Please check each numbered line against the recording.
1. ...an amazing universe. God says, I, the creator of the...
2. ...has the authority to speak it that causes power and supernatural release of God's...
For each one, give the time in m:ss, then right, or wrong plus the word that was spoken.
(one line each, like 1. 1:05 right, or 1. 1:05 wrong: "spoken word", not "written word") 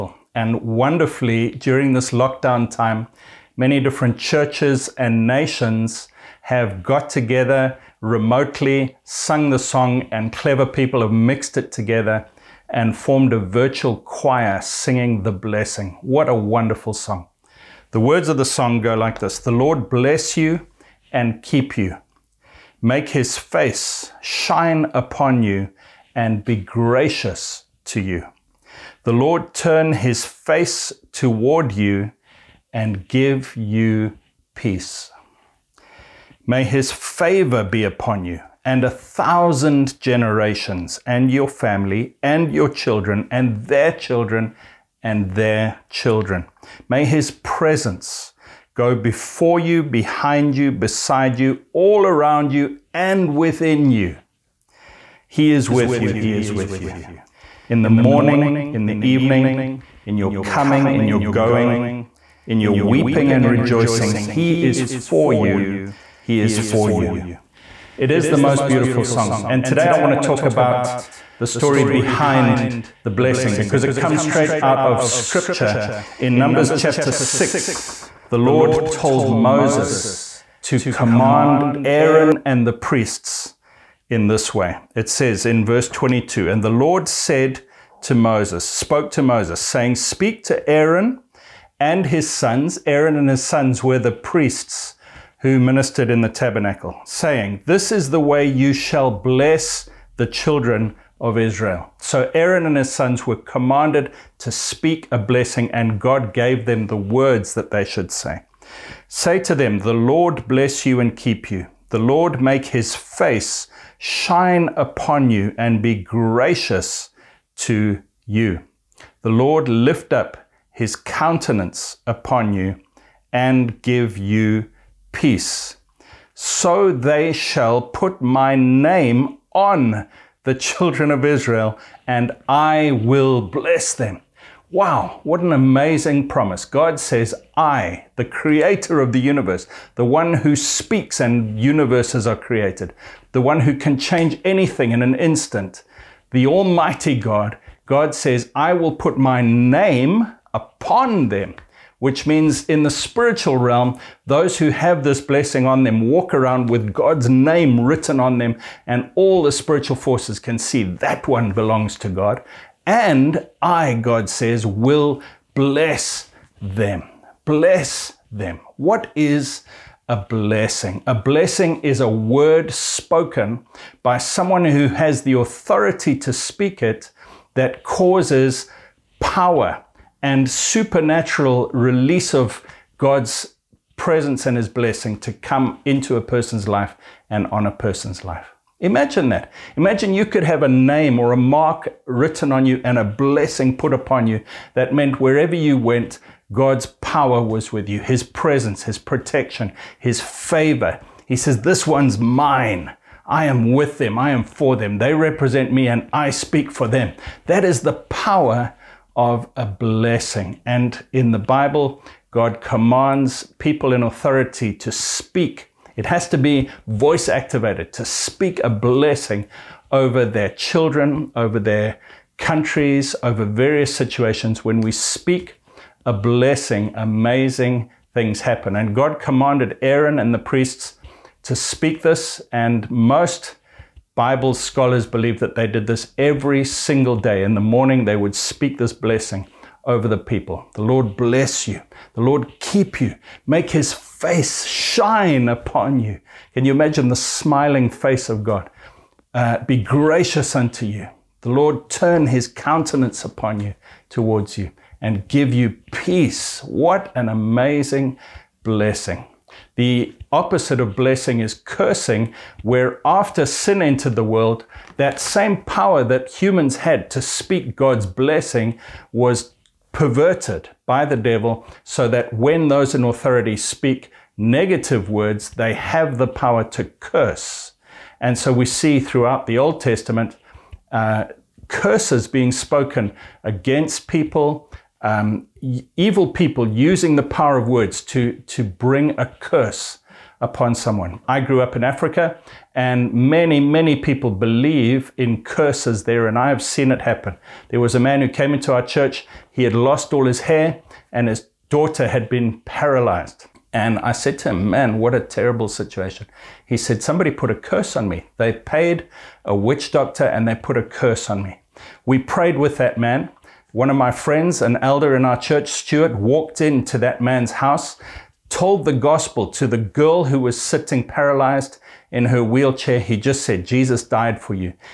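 1. 2:15 wrong: "promise", not "universe"
2. 2:54 right.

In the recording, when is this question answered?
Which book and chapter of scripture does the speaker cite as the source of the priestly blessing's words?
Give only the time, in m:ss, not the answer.
1:16.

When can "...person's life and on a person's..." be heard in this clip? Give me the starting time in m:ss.
3:06.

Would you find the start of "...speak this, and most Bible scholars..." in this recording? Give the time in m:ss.
3:51.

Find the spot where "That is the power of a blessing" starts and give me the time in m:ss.
3:27.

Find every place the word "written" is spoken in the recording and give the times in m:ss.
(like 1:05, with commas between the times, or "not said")
2:37, 3:12.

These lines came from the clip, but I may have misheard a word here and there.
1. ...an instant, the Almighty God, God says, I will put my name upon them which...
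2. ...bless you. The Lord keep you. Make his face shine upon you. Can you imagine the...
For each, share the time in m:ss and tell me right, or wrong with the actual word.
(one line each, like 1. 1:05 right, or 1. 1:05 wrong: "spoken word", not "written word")
1. 2:25 right
2. 4:01 right.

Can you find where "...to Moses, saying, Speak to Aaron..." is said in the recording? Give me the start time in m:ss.
1:29.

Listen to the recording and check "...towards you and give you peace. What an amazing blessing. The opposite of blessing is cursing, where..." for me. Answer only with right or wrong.
right.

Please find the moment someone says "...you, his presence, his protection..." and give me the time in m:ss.
3:17.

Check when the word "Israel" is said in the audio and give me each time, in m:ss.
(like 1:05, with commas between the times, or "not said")
1:41, 2:11.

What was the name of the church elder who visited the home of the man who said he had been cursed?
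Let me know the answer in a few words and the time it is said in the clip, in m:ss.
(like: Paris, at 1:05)
Stuart, at 5:15.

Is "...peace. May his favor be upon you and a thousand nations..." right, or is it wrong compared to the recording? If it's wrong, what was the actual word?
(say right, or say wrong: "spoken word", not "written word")
wrong: "generations", not "nations".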